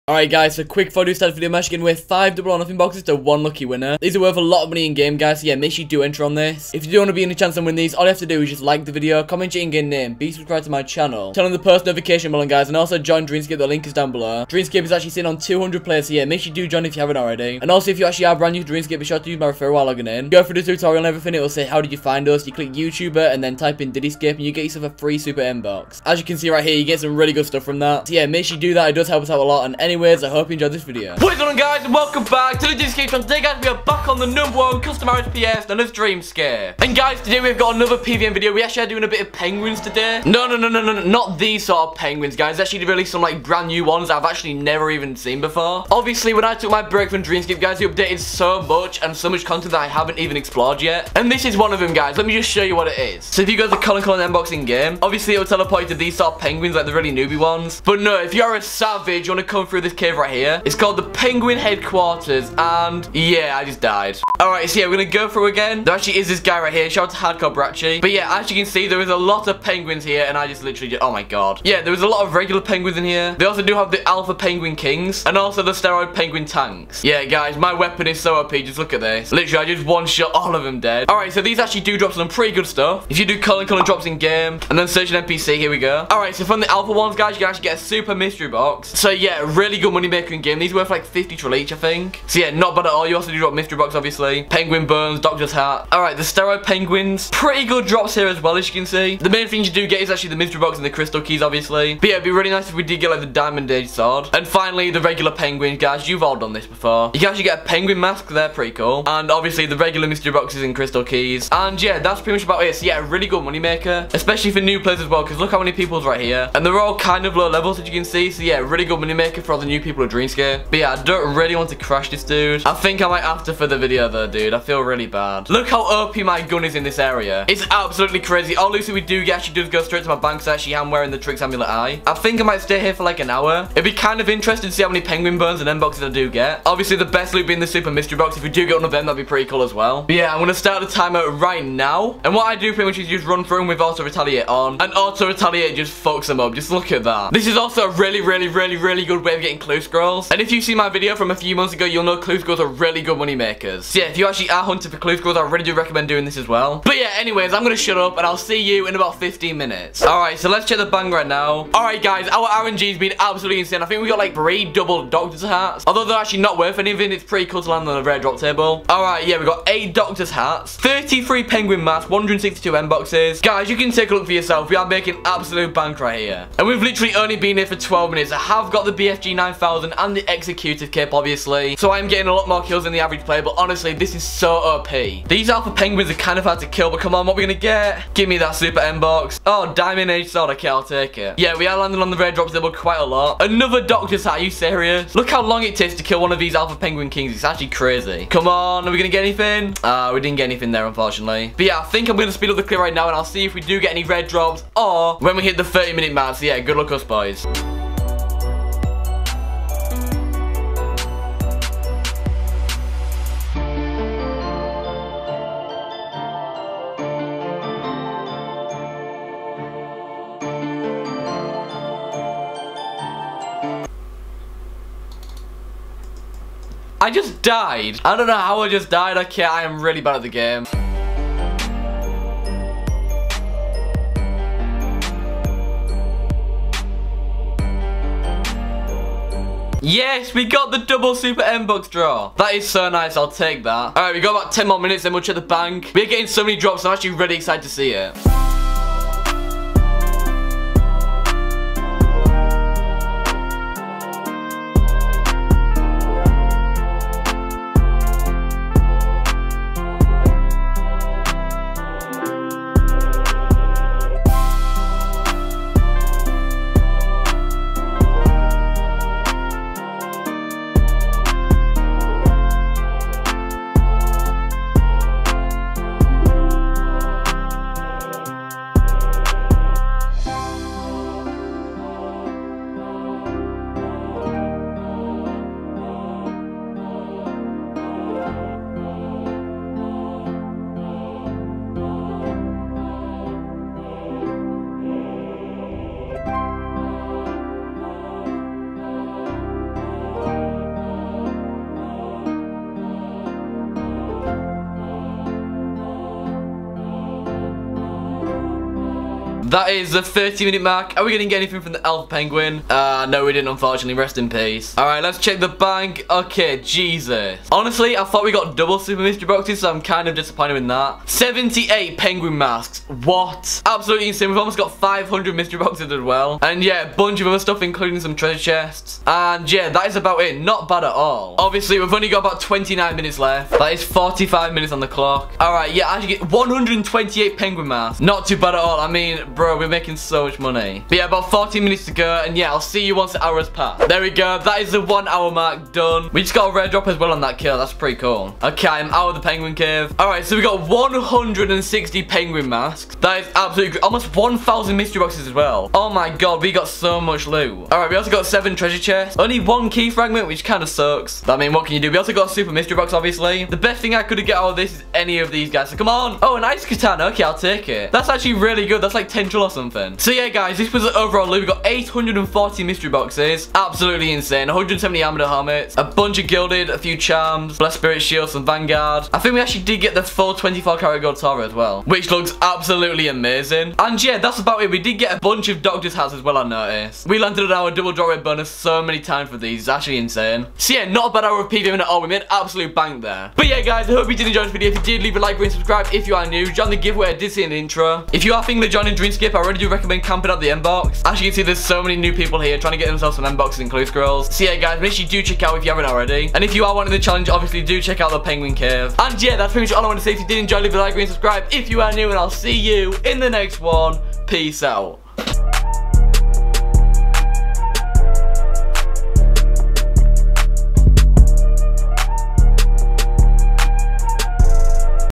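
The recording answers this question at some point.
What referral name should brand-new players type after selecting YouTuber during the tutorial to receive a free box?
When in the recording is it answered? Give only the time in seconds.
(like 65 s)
23 s.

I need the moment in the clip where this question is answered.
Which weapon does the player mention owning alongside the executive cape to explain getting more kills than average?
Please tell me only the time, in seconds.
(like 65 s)
178 s.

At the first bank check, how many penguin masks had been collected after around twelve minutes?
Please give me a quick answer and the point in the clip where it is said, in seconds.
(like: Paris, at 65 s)
33, at 170 s.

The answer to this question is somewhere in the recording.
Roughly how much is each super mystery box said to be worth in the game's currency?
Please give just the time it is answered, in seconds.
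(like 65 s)
91 s.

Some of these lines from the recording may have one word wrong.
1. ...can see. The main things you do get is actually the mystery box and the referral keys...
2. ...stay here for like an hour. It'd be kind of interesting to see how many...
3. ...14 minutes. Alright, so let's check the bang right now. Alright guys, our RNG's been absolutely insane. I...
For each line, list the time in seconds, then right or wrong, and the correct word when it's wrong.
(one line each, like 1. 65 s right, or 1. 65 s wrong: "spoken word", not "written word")
1. 98 s wrong: "crystal", not "referral"
2. 132 s right
3. 159 s wrong: "15", not "14".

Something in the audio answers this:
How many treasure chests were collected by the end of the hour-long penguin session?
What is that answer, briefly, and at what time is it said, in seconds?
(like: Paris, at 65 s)
7, at 358 s.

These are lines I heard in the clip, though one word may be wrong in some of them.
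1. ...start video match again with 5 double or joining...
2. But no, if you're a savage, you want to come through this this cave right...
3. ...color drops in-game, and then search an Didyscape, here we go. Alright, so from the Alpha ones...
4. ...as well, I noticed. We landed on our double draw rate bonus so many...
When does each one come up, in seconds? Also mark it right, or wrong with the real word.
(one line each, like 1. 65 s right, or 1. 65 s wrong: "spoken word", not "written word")
1. 1 s wrong: "nothing", not "joining"
2. 57 s right
3. 83 s wrong: "NPC", not "Didyscape"
4. 386 s right.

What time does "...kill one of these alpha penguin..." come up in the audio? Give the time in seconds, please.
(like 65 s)
196 s.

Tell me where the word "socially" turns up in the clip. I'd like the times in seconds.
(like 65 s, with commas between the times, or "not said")
not said.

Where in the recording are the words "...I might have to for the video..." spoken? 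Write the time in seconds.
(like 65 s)
123 s.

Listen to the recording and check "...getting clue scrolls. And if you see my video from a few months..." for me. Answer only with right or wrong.
right.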